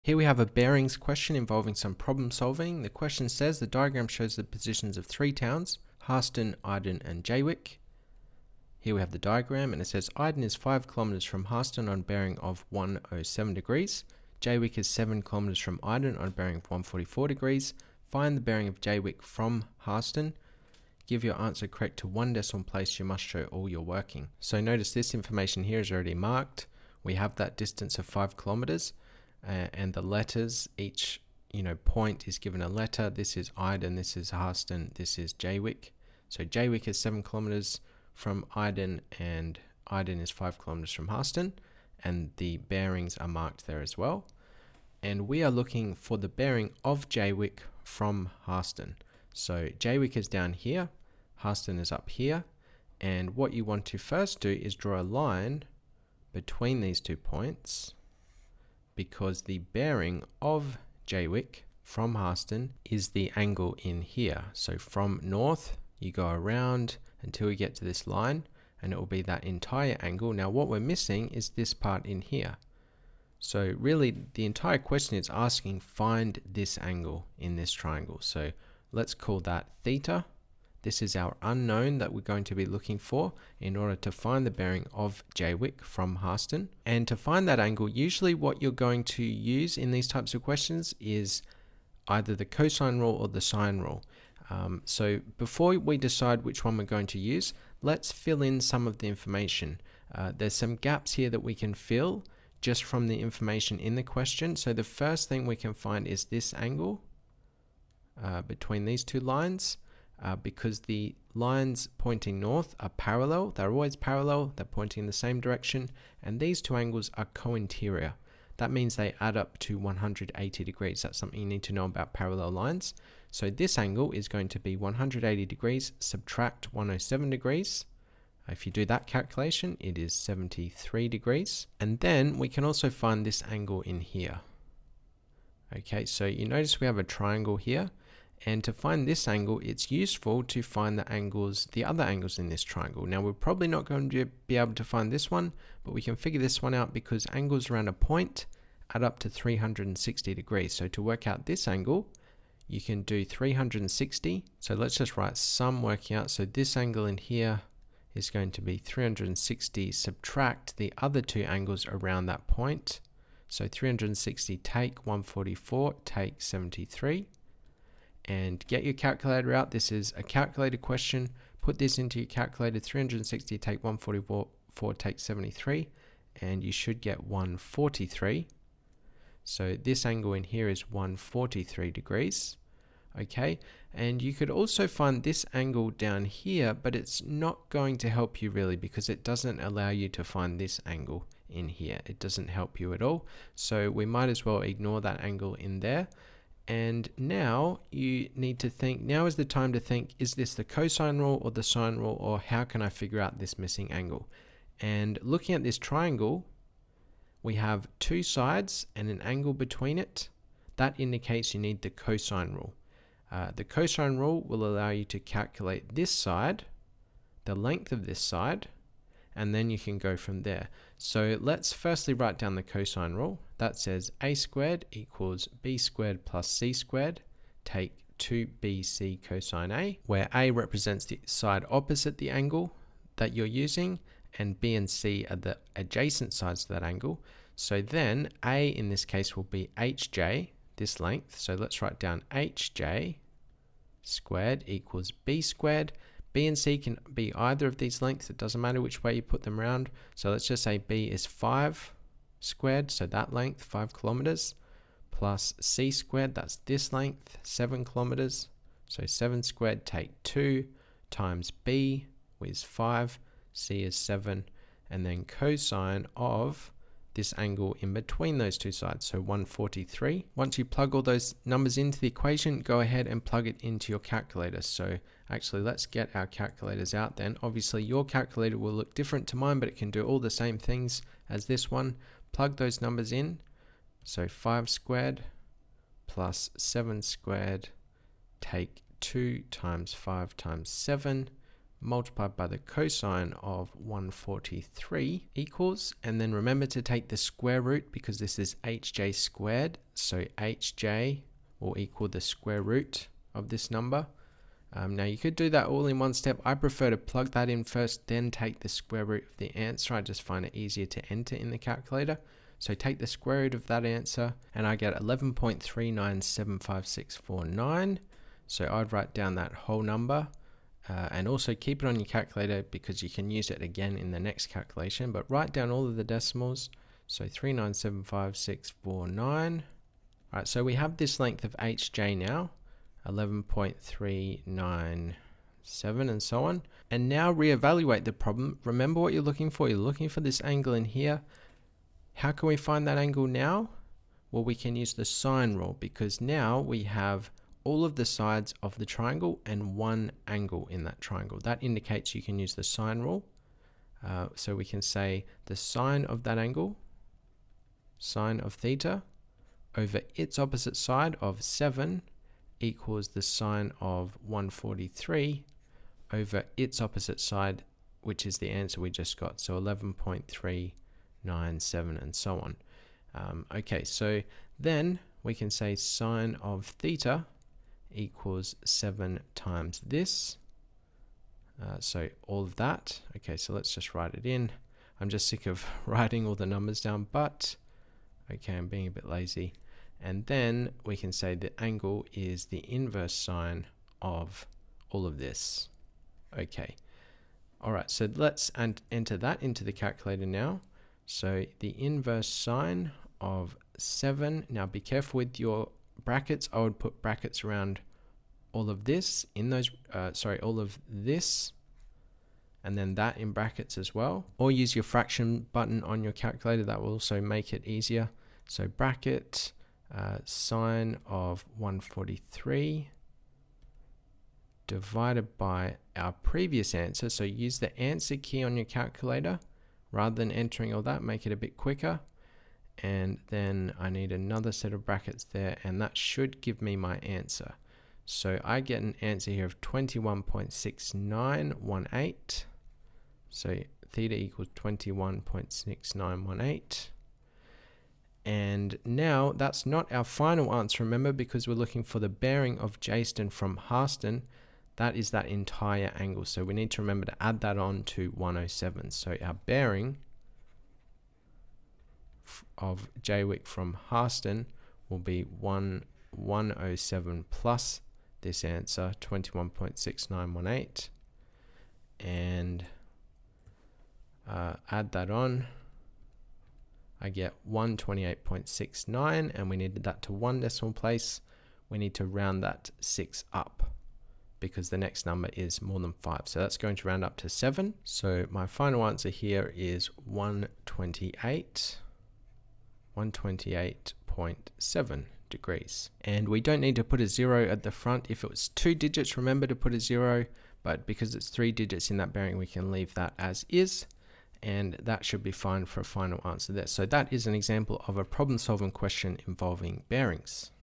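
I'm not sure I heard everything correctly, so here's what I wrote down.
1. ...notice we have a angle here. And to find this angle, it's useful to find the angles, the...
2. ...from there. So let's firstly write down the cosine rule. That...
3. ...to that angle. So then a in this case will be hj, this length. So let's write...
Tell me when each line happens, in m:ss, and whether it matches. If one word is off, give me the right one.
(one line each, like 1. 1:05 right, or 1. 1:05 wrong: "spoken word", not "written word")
1. 2:16 wrong: "triangle", not "angle"
2. 3:40 right
3. 3:56 right.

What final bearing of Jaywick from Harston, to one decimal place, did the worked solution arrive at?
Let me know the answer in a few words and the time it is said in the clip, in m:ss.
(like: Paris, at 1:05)
128.7 degrees, at 8:12.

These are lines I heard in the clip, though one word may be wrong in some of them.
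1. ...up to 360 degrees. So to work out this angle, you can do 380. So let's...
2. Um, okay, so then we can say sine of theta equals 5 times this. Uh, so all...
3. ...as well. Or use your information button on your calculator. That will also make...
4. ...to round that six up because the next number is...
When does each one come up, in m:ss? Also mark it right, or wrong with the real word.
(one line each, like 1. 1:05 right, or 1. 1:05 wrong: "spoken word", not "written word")
1. 2:29 wrong: "360", not "380"
2. 6:13 wrong: "7", not "5"
3. 6:53 wrong: "fraction", not "information"
4. 8:01 right.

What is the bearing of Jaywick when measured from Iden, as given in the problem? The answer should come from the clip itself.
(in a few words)
144 degrees.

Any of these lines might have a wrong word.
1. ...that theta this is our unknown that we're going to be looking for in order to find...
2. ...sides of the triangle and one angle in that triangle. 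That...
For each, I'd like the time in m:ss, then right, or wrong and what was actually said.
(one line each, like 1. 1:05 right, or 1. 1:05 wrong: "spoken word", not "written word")
1. 1:19 right
2. 5:48 right.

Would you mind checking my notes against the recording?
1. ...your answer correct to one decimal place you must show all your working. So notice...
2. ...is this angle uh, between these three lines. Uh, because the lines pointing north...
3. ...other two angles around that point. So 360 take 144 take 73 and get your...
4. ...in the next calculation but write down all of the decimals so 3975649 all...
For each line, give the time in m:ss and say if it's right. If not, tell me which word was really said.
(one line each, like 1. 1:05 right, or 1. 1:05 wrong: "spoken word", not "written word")
1. 0:21 right
2. 1:46 wrong: "two", not "three"
3. 2:40 right
4. 5:23 right.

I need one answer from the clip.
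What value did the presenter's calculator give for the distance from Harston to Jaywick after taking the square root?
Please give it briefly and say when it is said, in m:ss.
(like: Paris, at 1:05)
11.3975649, at 5:15.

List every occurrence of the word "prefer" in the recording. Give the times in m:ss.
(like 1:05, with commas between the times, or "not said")
5:06.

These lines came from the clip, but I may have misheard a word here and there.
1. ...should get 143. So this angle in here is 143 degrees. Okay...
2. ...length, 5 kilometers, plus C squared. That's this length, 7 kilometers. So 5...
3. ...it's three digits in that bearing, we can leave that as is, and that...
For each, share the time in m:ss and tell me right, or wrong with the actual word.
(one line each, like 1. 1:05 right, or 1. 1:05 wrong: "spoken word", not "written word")
1. 2:56 right
2. 4:13 wrong: "7", not "5"
3. 8:21 right.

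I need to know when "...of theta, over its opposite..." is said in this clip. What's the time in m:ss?
5:58.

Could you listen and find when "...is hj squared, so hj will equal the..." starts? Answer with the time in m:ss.
4:58.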